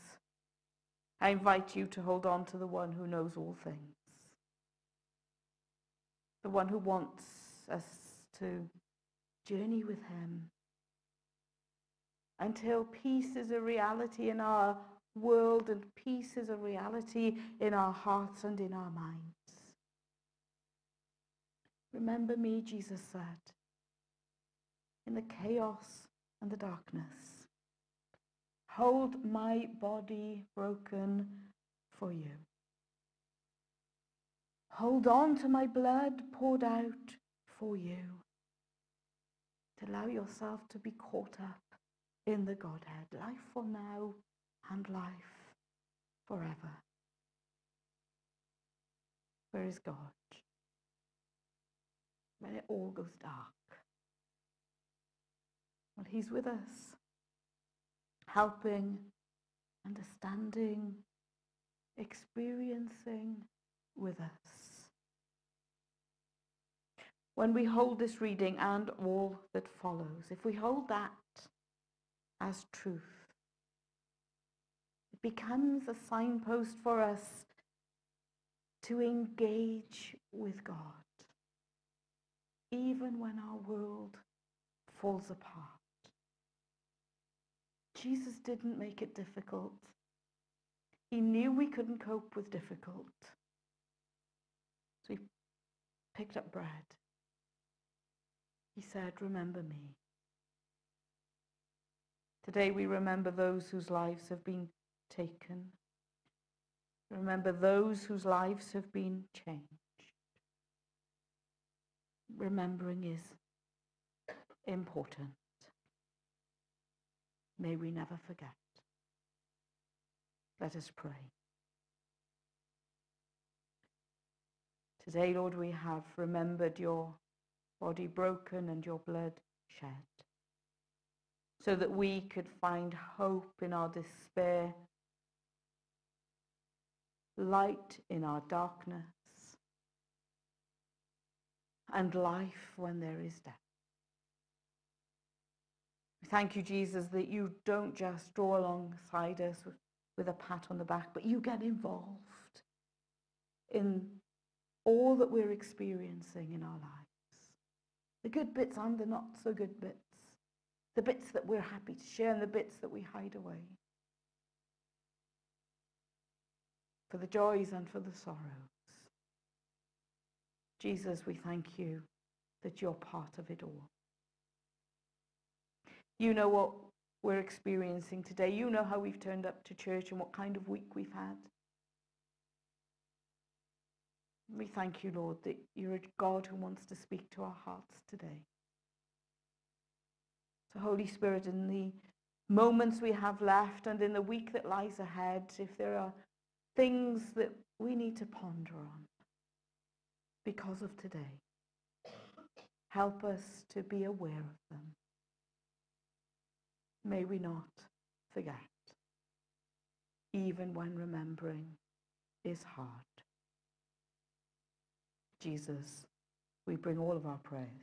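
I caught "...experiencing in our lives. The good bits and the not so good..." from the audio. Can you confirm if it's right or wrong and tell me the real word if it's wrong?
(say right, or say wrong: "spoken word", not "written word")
right.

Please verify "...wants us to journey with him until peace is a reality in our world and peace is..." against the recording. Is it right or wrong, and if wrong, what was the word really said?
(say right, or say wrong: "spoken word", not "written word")
right.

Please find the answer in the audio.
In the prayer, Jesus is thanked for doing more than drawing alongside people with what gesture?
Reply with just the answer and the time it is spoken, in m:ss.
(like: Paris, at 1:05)
A pat on the back, at 2:30.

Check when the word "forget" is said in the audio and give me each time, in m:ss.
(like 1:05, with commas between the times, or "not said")
1:58, 3:28.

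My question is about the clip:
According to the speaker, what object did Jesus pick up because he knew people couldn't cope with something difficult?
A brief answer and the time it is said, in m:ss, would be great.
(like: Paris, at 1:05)
Bread, at 1:36.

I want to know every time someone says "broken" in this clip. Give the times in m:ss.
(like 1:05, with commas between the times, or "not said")
0:30, 2:08.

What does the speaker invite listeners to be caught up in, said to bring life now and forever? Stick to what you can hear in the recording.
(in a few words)
The Godhead.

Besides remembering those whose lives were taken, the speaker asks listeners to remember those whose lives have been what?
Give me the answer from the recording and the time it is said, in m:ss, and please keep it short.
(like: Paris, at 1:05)
Changed, at 1:49.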